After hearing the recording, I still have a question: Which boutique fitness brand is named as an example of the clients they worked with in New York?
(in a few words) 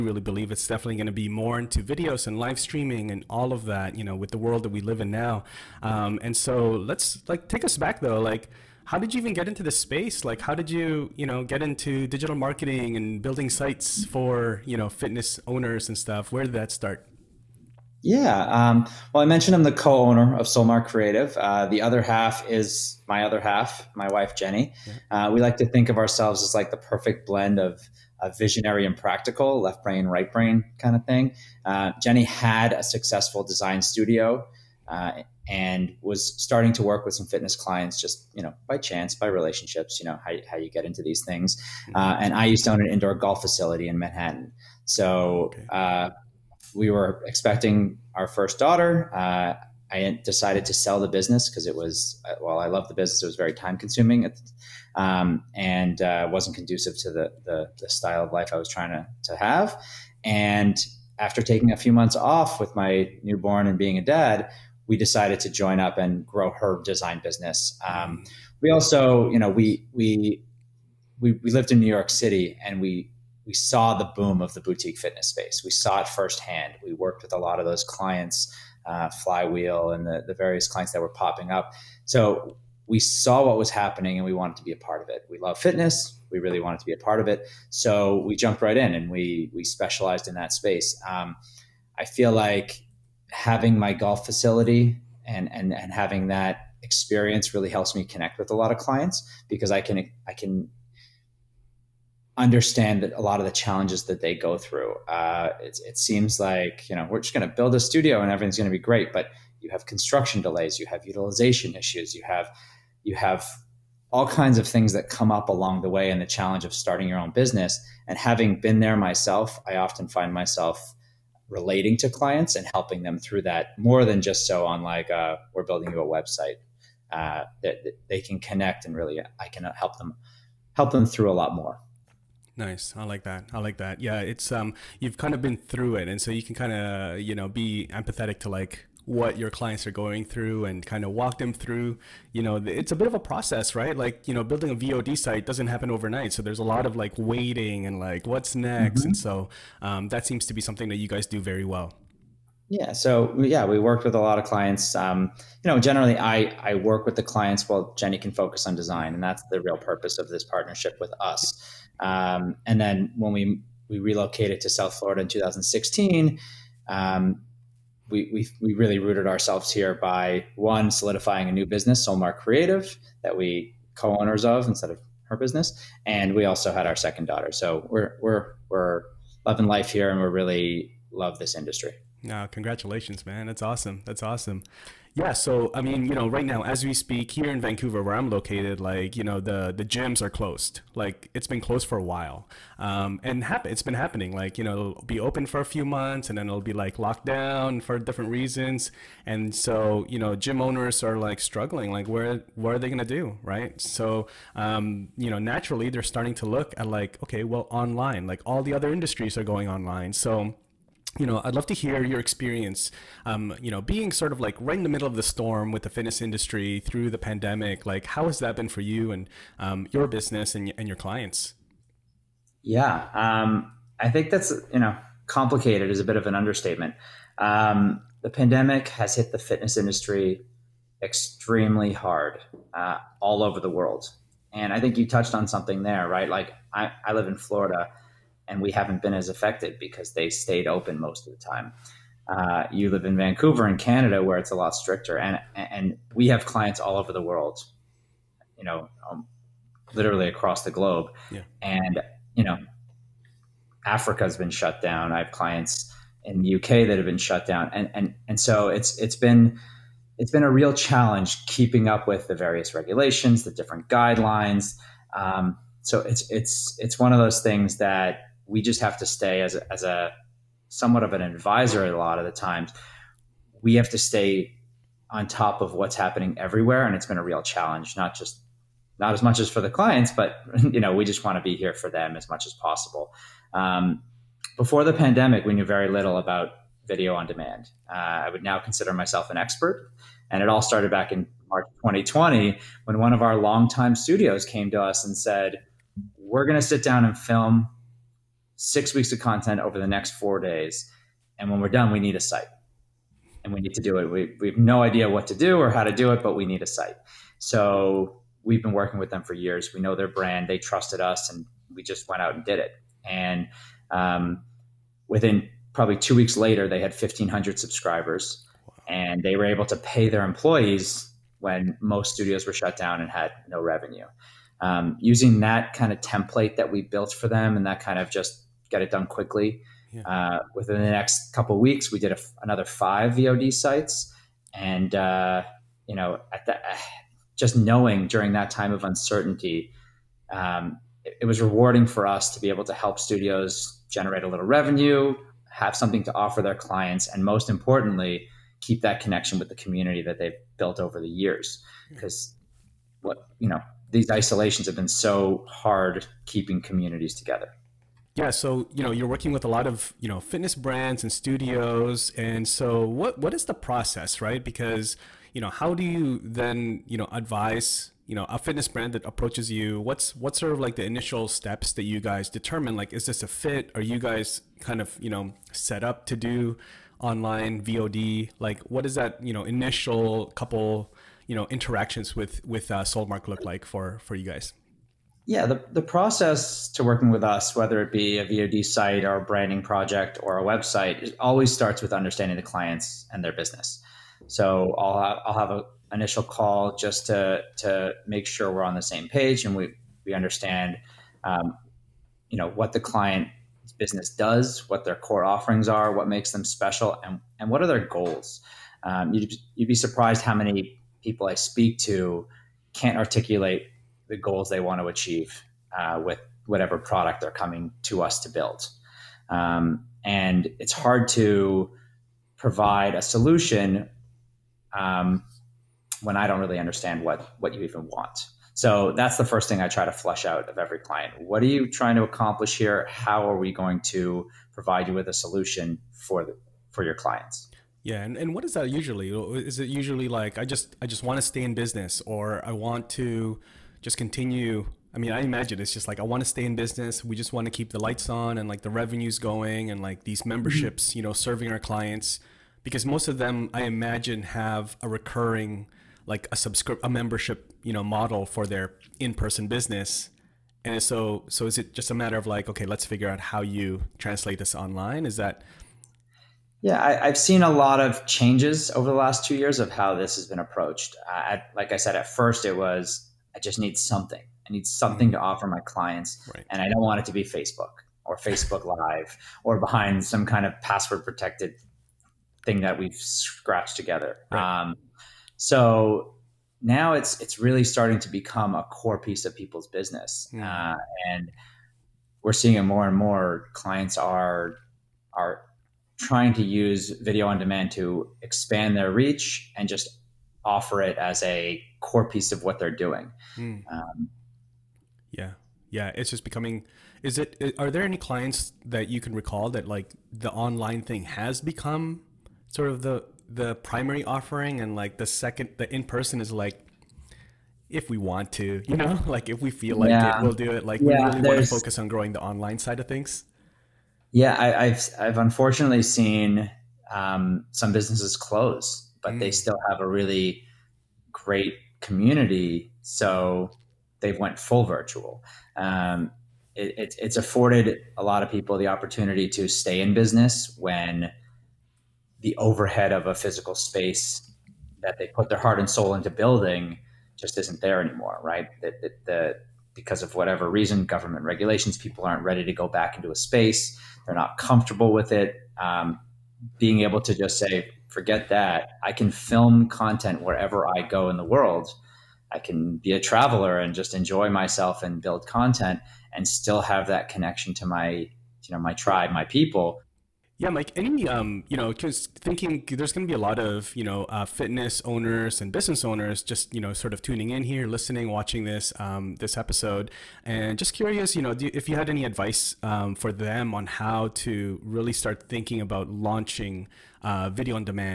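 Flywheel.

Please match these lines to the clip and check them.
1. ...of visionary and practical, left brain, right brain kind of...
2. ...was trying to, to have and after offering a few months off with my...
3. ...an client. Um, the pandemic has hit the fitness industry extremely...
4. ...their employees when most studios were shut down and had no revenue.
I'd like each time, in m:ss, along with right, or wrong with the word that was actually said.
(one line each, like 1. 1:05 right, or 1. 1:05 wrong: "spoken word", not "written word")
1. 0:27 right
2. 0:58 wrong: "taking", not "offering"
3. 3:46 wrong: "understatement", not "client"
4. 5:20 right.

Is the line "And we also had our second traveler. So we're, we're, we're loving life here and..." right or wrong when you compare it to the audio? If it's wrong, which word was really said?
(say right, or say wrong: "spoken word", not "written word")
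wrong: "daughter", not "traveler".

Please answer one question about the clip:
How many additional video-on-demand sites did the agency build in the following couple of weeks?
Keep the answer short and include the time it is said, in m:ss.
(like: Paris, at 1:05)
5, at 5:32.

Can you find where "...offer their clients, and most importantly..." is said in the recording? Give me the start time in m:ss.
5:46.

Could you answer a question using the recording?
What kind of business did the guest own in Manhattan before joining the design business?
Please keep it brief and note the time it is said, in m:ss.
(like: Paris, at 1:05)
indoor golf facility, at 0:42.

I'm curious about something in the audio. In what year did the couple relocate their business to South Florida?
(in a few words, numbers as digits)
2016.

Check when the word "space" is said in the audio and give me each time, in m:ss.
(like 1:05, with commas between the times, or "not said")
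0:09, 1:15, 1:30, 9:03, 9:13.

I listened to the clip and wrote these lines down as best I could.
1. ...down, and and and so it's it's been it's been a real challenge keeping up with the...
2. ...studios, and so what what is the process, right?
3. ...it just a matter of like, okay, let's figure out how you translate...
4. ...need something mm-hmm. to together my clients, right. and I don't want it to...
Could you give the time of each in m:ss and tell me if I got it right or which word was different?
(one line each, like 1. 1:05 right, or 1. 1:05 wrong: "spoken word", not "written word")
1. 4:17 right
2. 6:01 right
3. 7:41 right
4. 7:54 wrong: "offer", not "together".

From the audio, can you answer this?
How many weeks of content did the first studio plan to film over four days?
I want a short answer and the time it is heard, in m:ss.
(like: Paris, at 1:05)
6, at 4:58.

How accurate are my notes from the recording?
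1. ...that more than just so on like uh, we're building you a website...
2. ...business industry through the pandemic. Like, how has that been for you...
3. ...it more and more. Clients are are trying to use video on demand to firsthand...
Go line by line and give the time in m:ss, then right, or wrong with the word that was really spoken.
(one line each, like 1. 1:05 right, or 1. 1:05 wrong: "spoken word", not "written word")
1. 2:03 right
2. 3:35 wrong: "fitness", not "business"
3. 8:12 wrong: "expand", not "firsthand".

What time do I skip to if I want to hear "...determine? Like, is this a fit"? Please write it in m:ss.
6:12.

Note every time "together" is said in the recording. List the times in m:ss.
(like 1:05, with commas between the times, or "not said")
5:57, 8:03.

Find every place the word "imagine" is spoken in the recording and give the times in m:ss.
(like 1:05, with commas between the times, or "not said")
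7:25, 7:33.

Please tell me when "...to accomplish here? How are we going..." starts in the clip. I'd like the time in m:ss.
7:11.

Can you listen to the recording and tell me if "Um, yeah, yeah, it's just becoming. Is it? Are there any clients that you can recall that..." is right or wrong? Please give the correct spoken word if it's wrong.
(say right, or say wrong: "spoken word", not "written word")
right.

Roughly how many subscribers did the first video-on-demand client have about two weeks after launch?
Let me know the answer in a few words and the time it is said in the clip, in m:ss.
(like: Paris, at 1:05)
1,500, at 5:16.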